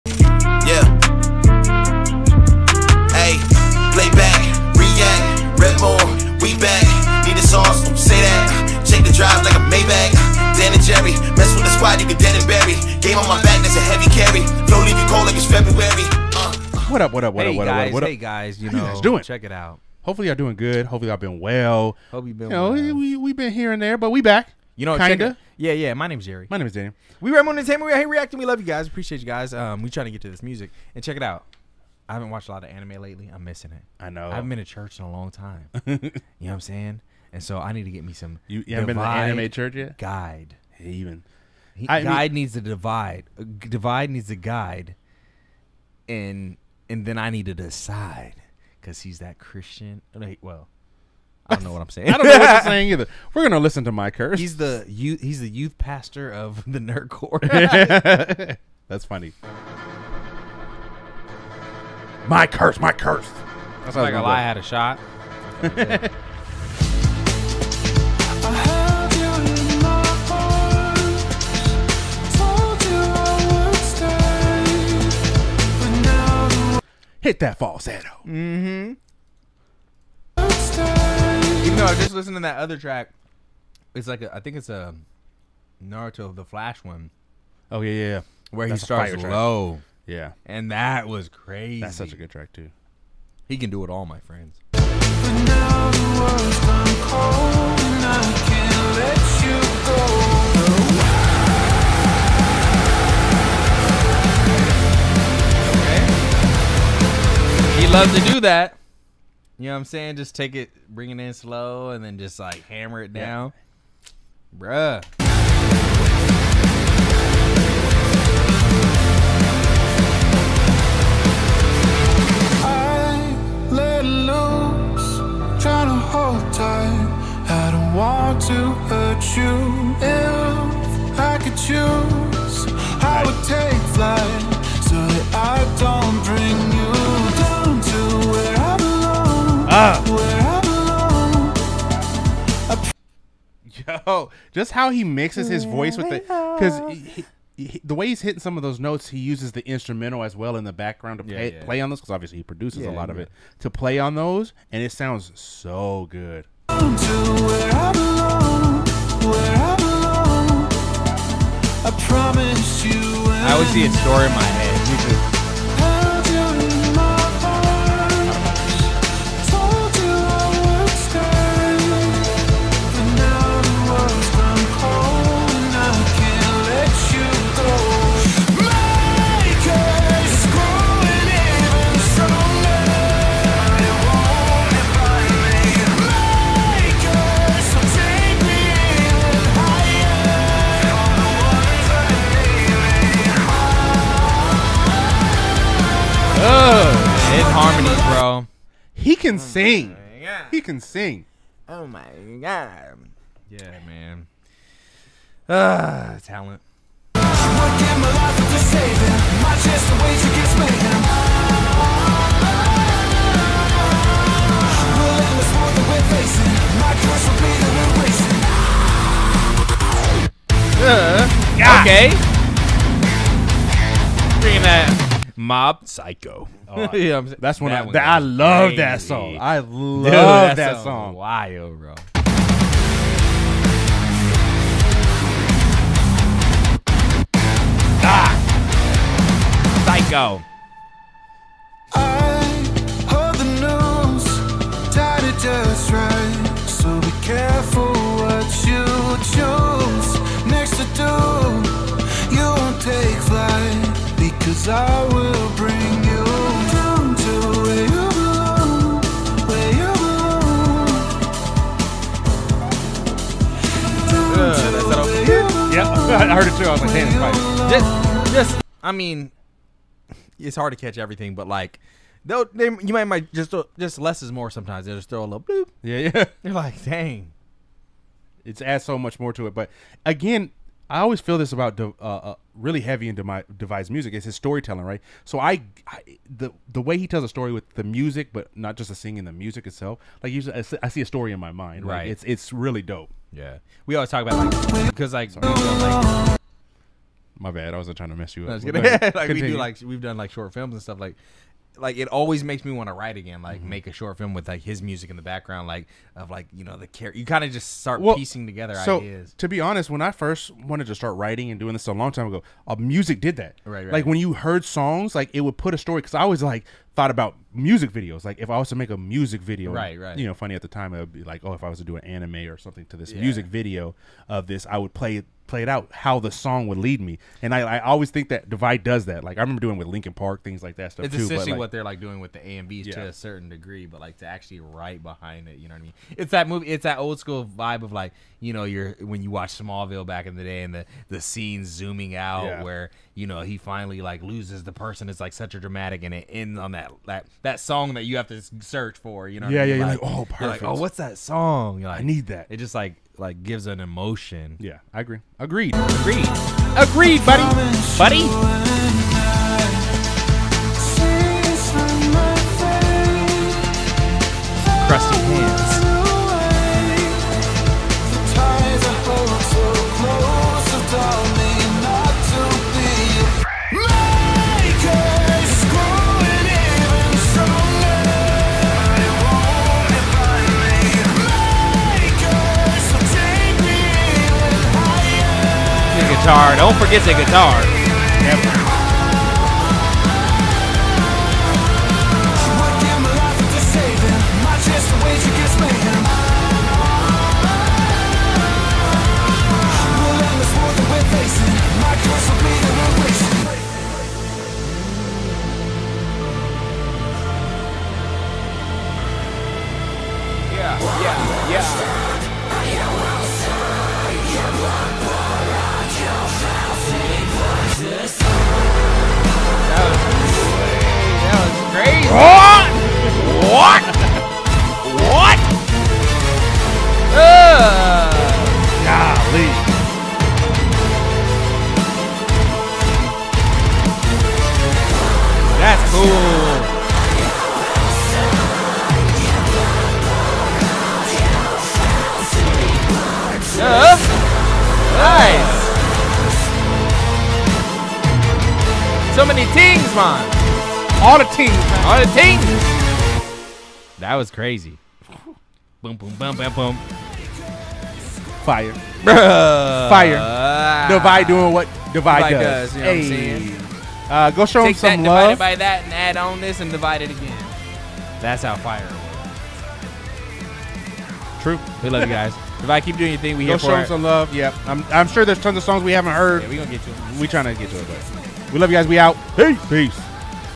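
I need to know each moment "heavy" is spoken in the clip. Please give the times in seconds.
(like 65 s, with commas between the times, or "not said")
282 s.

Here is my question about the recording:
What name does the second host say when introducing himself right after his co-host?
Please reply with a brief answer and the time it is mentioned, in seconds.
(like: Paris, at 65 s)
Daniel, at 26 s.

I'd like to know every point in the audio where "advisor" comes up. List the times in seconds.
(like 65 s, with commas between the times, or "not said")
not said.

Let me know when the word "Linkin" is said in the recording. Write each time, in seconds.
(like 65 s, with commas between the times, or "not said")
329 s.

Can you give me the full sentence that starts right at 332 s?
to a certain degree, but like to actually right behind it, you know what I mean?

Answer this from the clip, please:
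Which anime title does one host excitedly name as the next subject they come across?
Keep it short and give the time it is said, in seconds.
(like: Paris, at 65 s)
Mob Psycho, at 225 s.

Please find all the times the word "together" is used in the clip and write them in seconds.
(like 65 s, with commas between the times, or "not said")
308 s.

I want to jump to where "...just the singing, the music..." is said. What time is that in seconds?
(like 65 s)
288 s.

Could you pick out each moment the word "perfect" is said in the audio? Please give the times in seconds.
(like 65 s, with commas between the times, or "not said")
350 s.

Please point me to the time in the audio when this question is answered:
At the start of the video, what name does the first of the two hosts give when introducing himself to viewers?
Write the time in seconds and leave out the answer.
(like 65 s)
26 s.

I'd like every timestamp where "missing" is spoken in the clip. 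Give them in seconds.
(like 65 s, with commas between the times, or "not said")
33 s.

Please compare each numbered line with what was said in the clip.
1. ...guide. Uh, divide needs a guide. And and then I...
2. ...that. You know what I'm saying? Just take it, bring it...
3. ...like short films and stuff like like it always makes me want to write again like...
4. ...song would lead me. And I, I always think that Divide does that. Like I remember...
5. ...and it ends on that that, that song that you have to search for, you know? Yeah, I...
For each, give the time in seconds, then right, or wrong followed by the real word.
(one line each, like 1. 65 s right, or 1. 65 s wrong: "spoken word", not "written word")
1. 42 s wrong: "divide", not "guide"
2. 108 s right
3. 300 s right
4. 326 s right
5. 346 s right.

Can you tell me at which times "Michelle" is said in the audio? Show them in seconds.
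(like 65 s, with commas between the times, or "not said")
not said.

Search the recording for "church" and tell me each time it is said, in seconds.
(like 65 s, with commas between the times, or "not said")
34 s, 39 s.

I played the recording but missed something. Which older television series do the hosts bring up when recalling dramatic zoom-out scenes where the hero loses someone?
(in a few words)
Smallville.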